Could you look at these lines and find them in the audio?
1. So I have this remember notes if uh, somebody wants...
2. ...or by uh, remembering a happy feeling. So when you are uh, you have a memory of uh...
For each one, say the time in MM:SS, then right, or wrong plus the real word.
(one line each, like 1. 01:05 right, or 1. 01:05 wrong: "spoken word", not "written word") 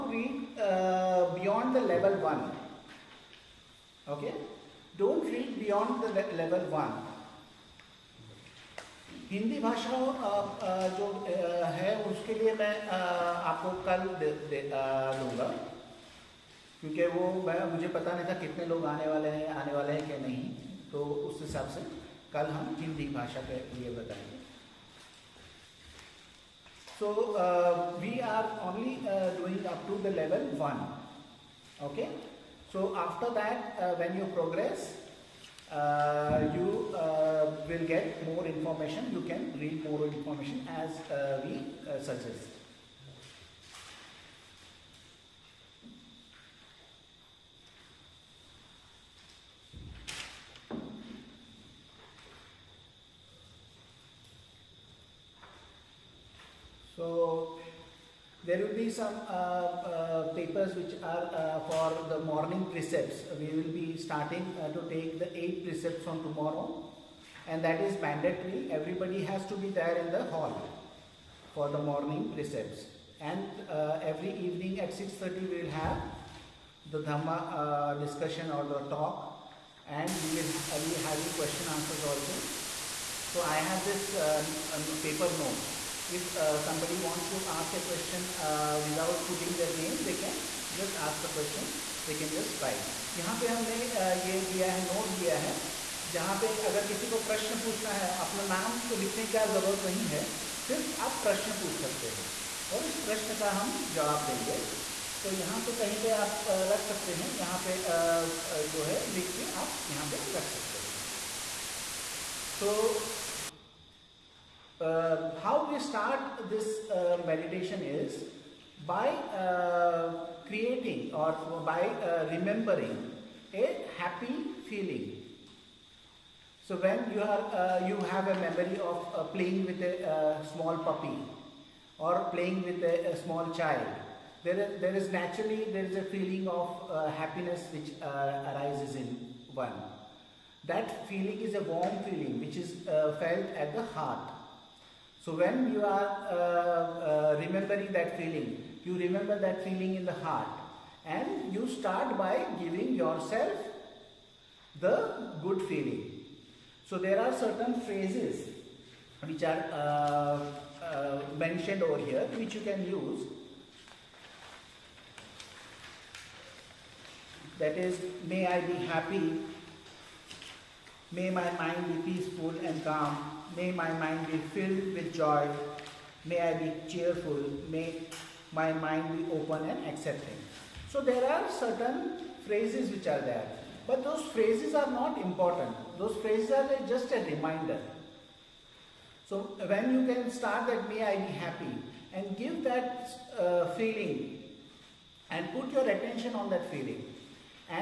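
1. 01:23 wrong: "paper", not "remember"
2. 02:01 right.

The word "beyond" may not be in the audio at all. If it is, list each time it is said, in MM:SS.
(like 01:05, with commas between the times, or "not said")
00:01, 00:05.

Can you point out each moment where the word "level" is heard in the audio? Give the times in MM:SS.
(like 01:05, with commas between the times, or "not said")
00:01, 00:06, 00:30.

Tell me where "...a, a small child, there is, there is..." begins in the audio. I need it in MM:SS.
02:12.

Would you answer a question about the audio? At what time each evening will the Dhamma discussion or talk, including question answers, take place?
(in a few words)
6:30.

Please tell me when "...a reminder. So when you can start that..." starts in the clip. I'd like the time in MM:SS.
03:07.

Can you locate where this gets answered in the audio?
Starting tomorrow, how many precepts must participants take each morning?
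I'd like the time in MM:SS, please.
01:05.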